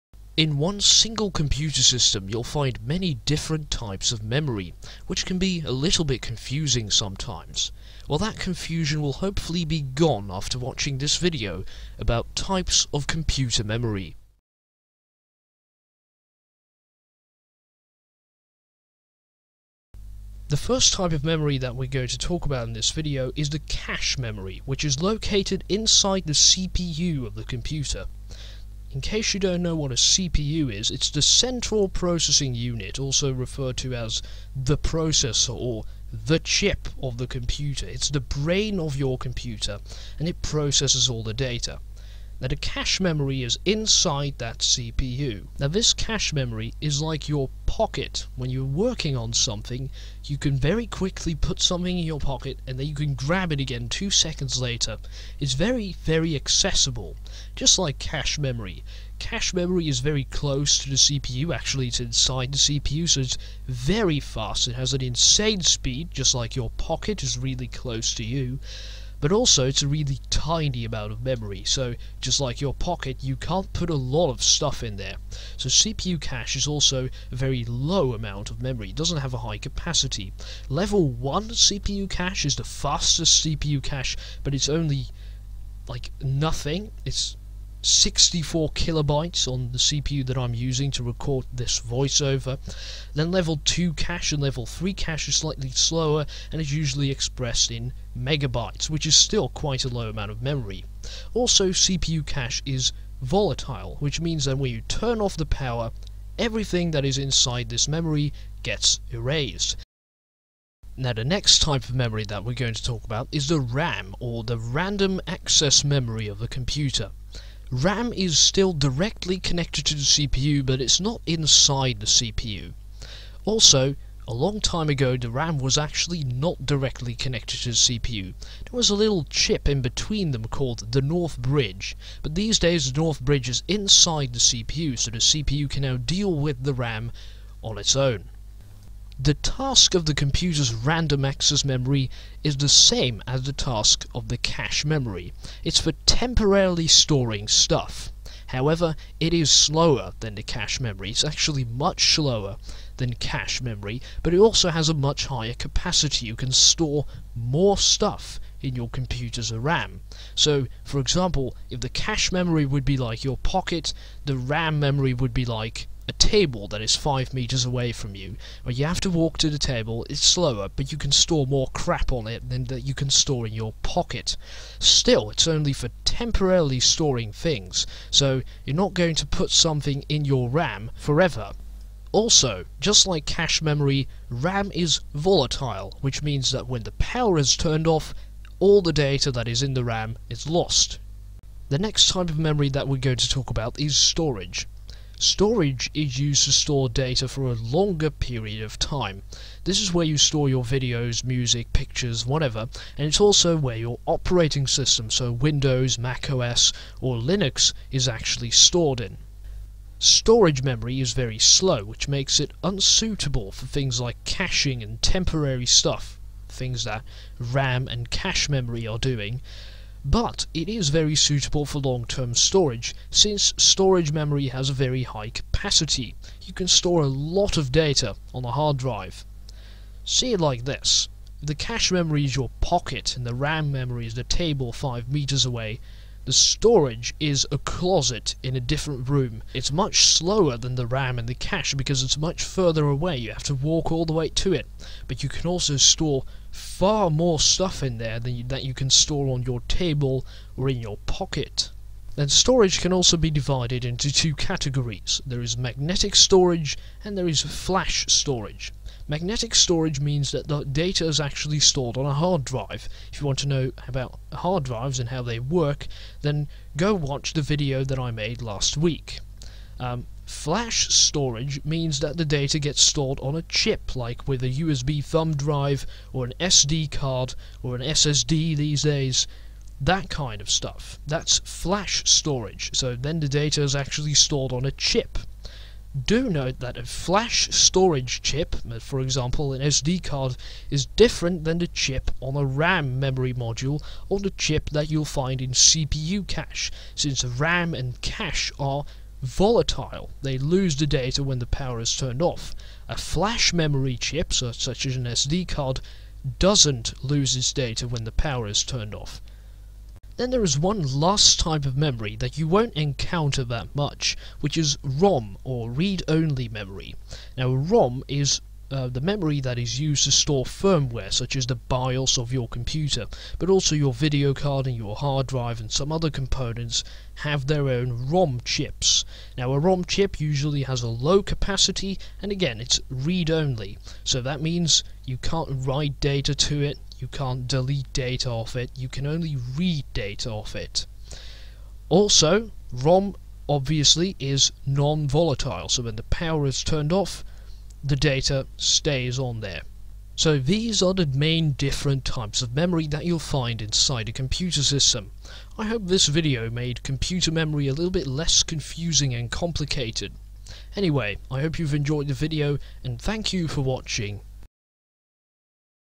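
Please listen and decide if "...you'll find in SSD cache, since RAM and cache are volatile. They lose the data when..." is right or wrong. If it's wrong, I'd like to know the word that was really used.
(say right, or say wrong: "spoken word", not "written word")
wrong: "CPU", not "SSD".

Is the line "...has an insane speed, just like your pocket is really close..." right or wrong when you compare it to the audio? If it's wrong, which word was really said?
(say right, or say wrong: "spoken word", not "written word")
right.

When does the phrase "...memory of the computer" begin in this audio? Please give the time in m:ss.
1:55.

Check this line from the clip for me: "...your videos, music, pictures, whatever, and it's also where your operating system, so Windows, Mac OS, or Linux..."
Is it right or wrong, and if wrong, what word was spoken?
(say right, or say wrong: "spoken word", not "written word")
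right.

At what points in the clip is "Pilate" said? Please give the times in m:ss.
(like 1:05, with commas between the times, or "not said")
not said.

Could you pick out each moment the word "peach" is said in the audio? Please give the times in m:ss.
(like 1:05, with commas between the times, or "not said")
not said.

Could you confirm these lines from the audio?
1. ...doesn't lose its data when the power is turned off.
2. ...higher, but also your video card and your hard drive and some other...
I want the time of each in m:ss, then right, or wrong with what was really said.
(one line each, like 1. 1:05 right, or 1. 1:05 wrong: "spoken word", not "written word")
1. 5:06 right
2. 5:22 wrong: "computer", not "higher".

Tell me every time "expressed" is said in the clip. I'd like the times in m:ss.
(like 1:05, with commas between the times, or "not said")
1:37.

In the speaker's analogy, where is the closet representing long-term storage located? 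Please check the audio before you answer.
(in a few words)
a different room.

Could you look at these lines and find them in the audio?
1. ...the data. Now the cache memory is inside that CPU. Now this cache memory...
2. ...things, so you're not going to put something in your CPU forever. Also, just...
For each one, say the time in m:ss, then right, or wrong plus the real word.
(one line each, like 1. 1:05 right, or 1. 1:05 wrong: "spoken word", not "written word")
1. 0:41 right
2. 2:57 wrong: "RAM", not "CPU".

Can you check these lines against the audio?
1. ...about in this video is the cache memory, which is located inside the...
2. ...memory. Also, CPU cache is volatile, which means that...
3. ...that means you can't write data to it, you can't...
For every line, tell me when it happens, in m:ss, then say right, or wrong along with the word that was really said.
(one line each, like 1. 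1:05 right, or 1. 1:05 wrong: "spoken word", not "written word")
1. 0:22 right
2. 1:40 right
3. 5:34 right.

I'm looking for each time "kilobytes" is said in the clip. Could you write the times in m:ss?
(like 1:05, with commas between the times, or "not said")
1:28.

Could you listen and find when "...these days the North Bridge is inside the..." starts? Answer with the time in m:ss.
2:12.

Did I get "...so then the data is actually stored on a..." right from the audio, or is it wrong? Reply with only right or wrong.
right.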